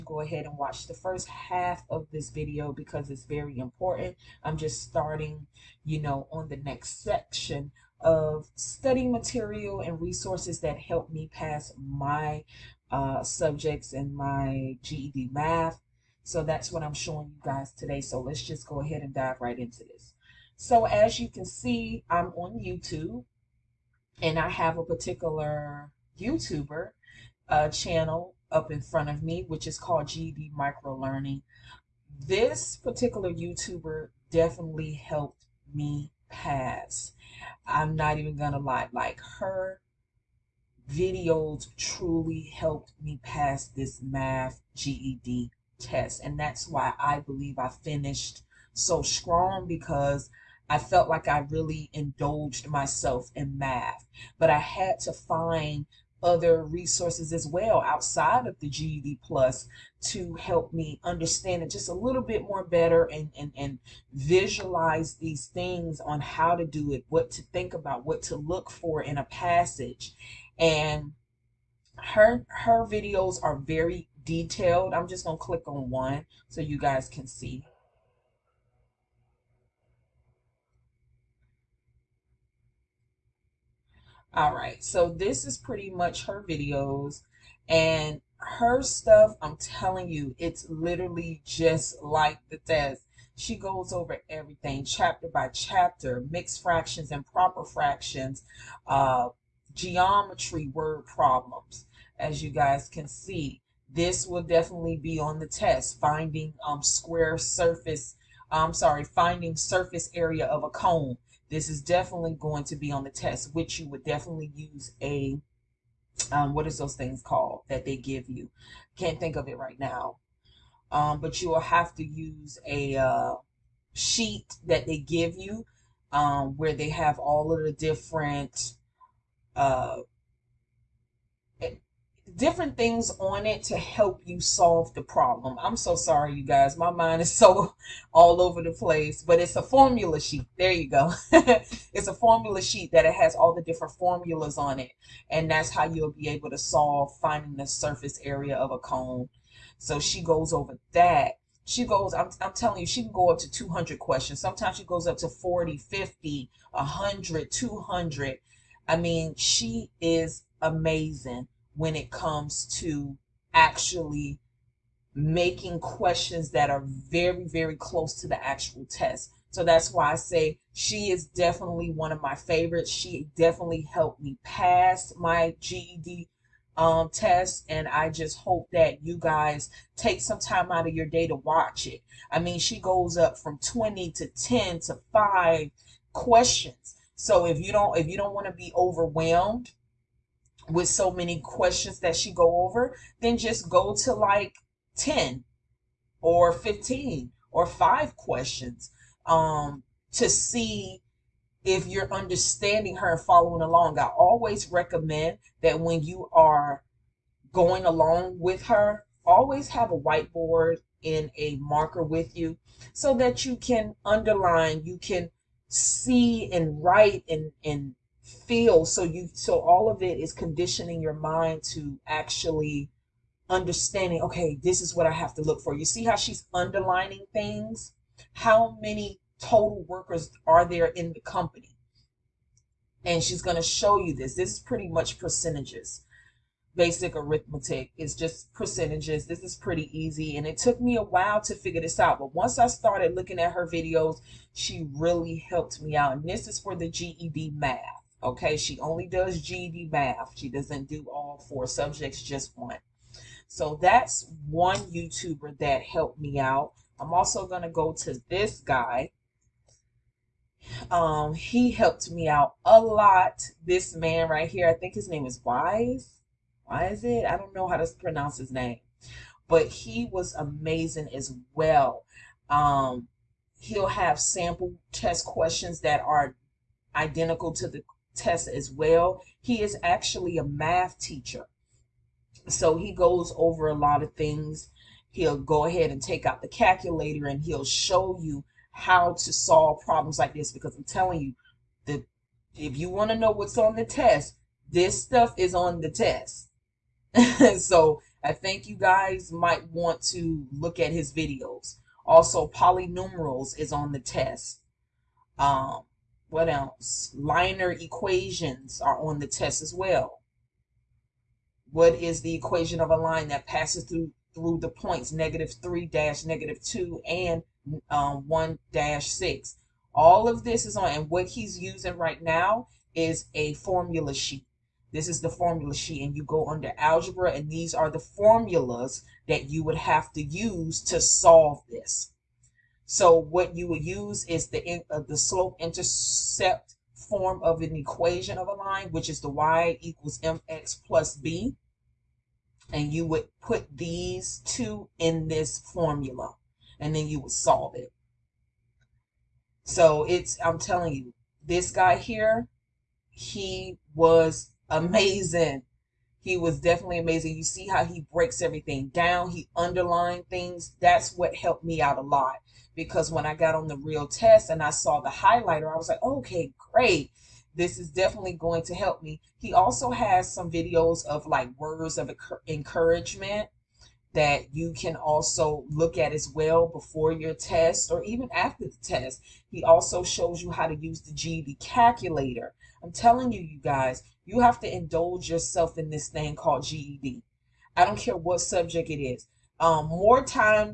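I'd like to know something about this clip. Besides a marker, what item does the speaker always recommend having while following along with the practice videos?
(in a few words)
Whiteboard.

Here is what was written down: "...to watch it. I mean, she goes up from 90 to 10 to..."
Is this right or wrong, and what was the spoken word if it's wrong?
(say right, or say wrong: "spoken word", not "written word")
wrong: "20", not "90".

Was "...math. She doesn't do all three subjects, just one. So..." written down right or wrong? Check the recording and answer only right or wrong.
wrong.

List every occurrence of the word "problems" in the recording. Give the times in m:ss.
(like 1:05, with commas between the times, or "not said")
1:41, 2:15, 4:49.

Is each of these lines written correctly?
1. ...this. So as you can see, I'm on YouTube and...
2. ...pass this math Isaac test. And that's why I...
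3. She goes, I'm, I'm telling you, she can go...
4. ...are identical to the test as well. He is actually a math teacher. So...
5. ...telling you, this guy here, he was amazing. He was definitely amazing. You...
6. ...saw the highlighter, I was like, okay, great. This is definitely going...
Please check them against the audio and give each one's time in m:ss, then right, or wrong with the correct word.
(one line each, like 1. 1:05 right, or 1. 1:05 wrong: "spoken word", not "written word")
1. 0:19 right
2. 0:43 wrong: "GED", not "Isaac"
3. 2:31 right
4. 4:36 right
5. 5:50 right
6. 6:04 right.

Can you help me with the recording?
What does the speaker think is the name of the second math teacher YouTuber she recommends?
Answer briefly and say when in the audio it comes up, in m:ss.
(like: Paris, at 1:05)
Wise Isaac, at 4:25.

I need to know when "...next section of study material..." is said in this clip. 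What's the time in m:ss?
0:06.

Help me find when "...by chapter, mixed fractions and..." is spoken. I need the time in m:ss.
1:35.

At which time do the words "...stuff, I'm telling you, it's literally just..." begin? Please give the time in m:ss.
1:28.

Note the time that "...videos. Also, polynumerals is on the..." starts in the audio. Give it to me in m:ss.
5:01.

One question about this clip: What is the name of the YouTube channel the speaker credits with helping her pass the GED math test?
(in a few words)
GED Micro Learning.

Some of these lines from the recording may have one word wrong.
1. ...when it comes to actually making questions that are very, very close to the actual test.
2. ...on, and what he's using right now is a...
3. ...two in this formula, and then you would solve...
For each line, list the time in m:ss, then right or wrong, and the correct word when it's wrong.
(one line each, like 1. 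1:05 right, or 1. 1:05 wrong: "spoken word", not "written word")
1. 2:41 right
2. 5:20 right
3. 5:44 right.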